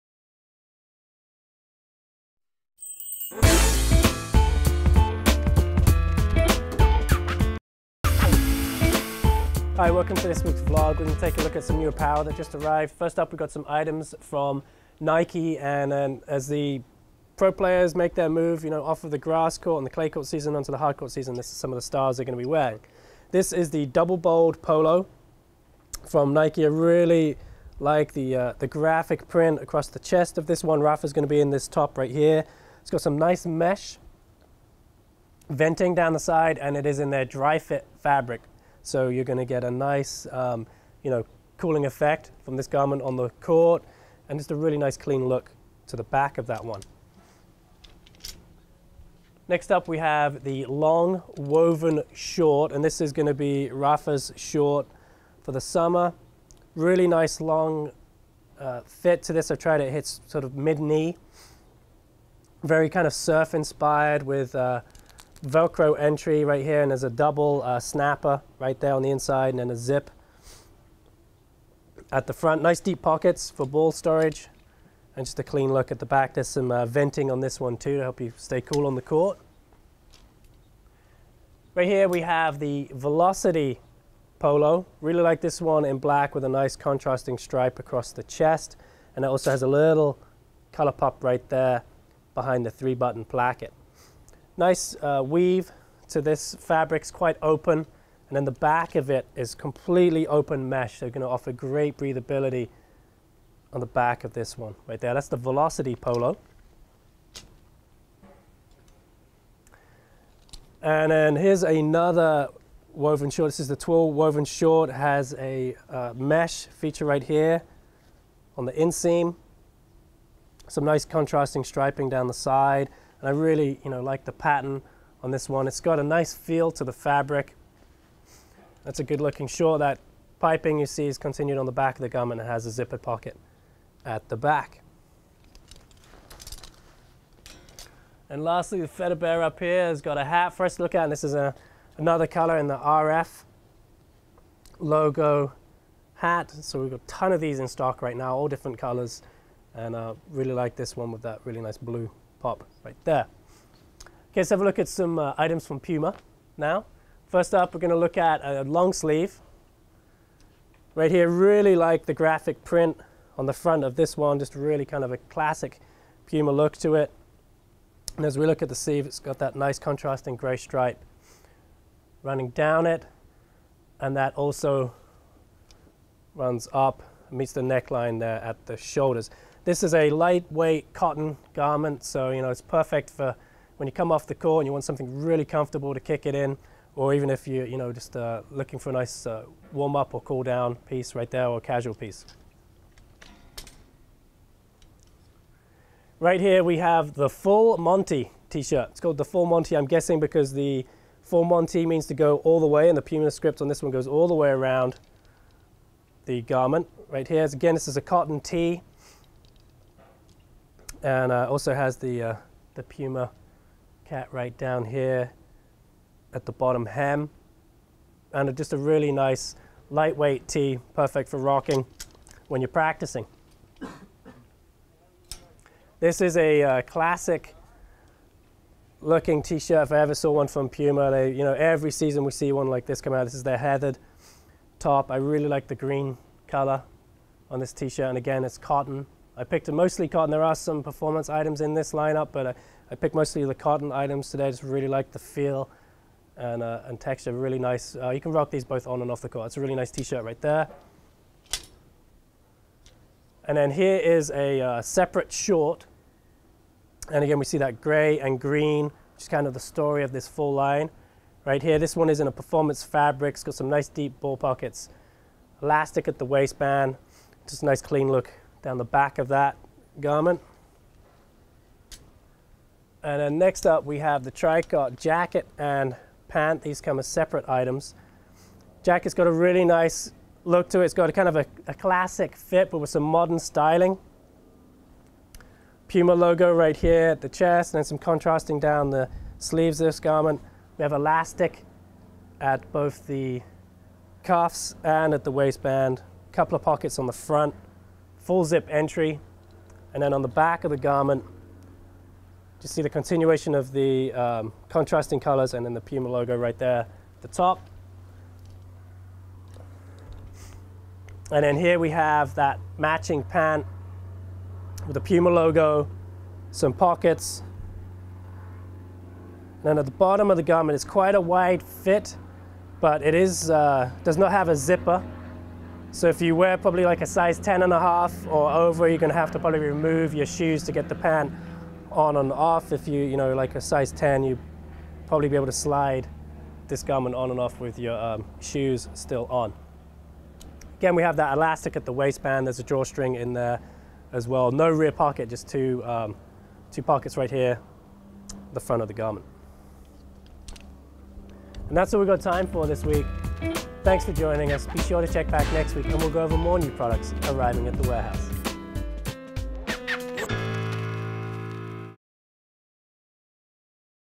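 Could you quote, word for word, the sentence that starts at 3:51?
They, you know, every season we see one like this come out.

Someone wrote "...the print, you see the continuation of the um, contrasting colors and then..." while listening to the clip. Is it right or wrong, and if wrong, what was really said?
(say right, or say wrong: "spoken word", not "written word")
wrong: "garment", not "print".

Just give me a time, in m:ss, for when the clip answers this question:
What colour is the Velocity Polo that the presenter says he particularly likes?
1:25.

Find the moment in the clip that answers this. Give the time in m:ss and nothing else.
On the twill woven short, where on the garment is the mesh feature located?
1:58.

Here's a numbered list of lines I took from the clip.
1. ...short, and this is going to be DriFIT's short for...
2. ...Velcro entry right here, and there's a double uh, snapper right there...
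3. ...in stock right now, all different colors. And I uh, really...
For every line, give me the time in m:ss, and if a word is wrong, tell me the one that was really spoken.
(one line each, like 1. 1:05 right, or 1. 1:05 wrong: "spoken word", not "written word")
1. 0:52 wrong: "Rafa", not "DriFIT"
2. 1:05 right
3. 2:27 right.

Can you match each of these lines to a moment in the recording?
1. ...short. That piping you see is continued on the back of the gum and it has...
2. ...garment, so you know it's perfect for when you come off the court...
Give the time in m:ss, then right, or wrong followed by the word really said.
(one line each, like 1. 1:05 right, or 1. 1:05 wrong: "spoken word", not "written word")
1. 2:09 right
2. 3:01 right.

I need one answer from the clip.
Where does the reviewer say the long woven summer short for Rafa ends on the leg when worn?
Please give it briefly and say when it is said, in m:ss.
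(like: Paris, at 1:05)
Mid knee, at 1:00.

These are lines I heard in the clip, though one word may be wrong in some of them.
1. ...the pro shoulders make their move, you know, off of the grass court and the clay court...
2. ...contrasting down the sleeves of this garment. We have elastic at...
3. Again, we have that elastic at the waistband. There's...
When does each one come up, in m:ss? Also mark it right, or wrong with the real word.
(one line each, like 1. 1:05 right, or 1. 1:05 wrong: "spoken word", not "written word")
1. 0:16 wrong: "players", not "shoulders"
2. 4:47 right
3. 5:40 right.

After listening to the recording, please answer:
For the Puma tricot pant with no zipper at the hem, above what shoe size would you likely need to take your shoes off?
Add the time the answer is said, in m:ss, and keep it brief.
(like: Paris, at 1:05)
10 and a half, at 5:27.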